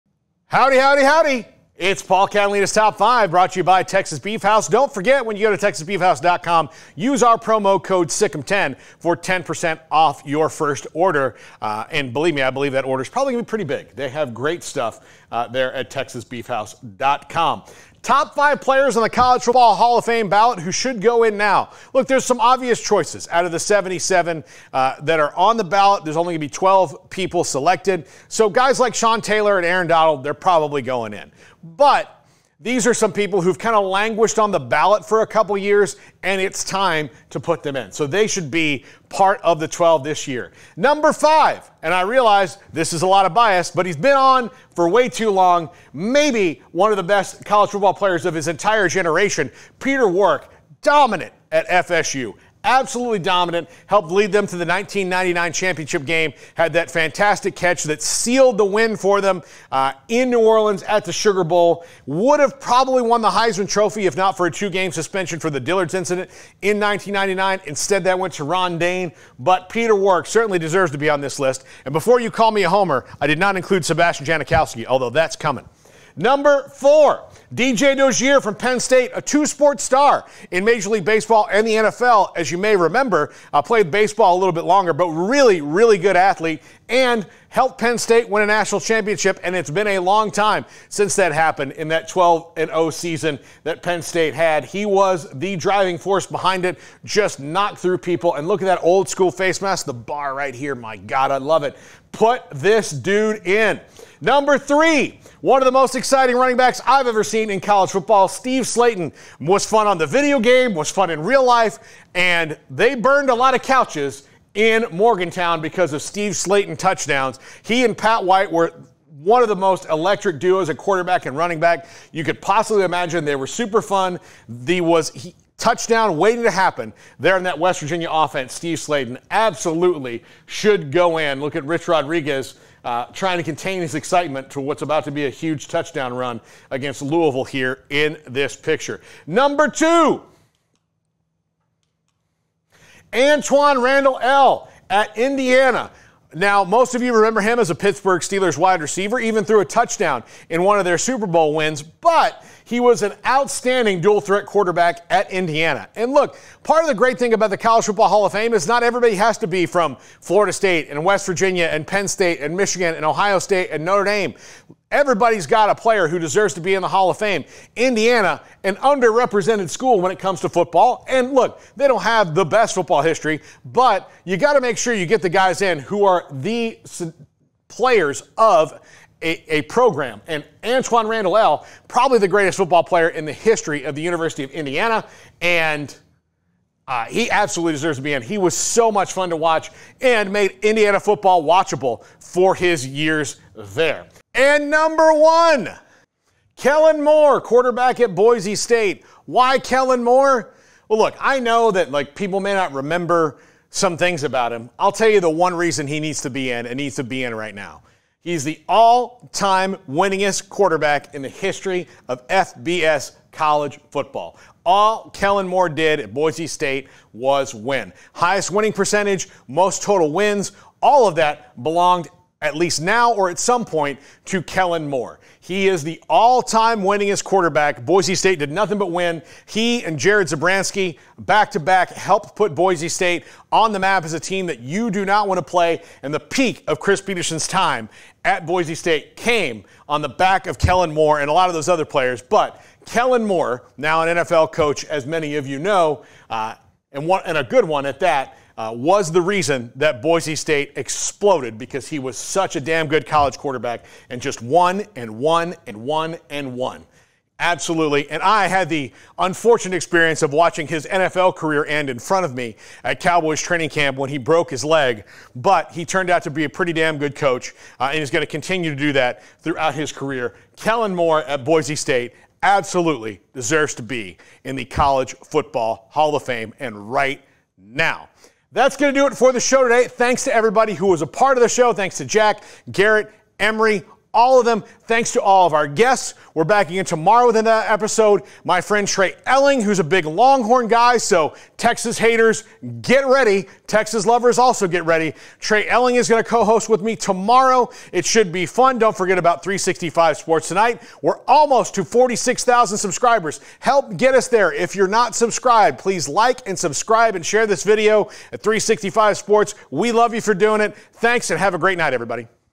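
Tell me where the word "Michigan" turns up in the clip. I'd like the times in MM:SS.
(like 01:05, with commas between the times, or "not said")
02:42.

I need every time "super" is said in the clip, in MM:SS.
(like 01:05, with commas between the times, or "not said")
02:03, 02:30.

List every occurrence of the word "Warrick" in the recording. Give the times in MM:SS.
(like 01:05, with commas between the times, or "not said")
00:50, 01:09.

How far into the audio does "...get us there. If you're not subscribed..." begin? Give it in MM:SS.
05:03.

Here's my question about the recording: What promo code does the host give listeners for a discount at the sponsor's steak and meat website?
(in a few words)
SICKM10.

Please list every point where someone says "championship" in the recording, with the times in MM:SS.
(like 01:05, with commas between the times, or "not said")
00:55, 01:28.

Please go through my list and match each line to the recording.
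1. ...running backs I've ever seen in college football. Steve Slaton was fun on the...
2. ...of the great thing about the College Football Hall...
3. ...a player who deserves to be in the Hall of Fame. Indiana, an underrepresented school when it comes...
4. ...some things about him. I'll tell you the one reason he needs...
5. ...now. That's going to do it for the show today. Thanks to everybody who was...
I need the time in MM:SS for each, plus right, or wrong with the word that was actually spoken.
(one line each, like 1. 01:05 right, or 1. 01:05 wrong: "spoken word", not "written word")
1. 01:46 right
2. 02:36 right
3. 02:45 right
4. 03:23 right
5. 04:37 right.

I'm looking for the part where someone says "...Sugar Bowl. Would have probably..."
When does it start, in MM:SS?
01:01.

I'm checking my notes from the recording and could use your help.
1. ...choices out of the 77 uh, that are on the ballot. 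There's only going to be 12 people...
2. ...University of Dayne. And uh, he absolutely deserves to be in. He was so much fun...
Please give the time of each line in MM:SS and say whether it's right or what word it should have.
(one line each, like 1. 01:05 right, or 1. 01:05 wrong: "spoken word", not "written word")
1. 00:22 right
2. 03:04 wrong: "Indiana", not "Dayne".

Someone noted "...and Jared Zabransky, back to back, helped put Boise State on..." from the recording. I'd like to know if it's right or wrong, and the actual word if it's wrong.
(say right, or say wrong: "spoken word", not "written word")
right.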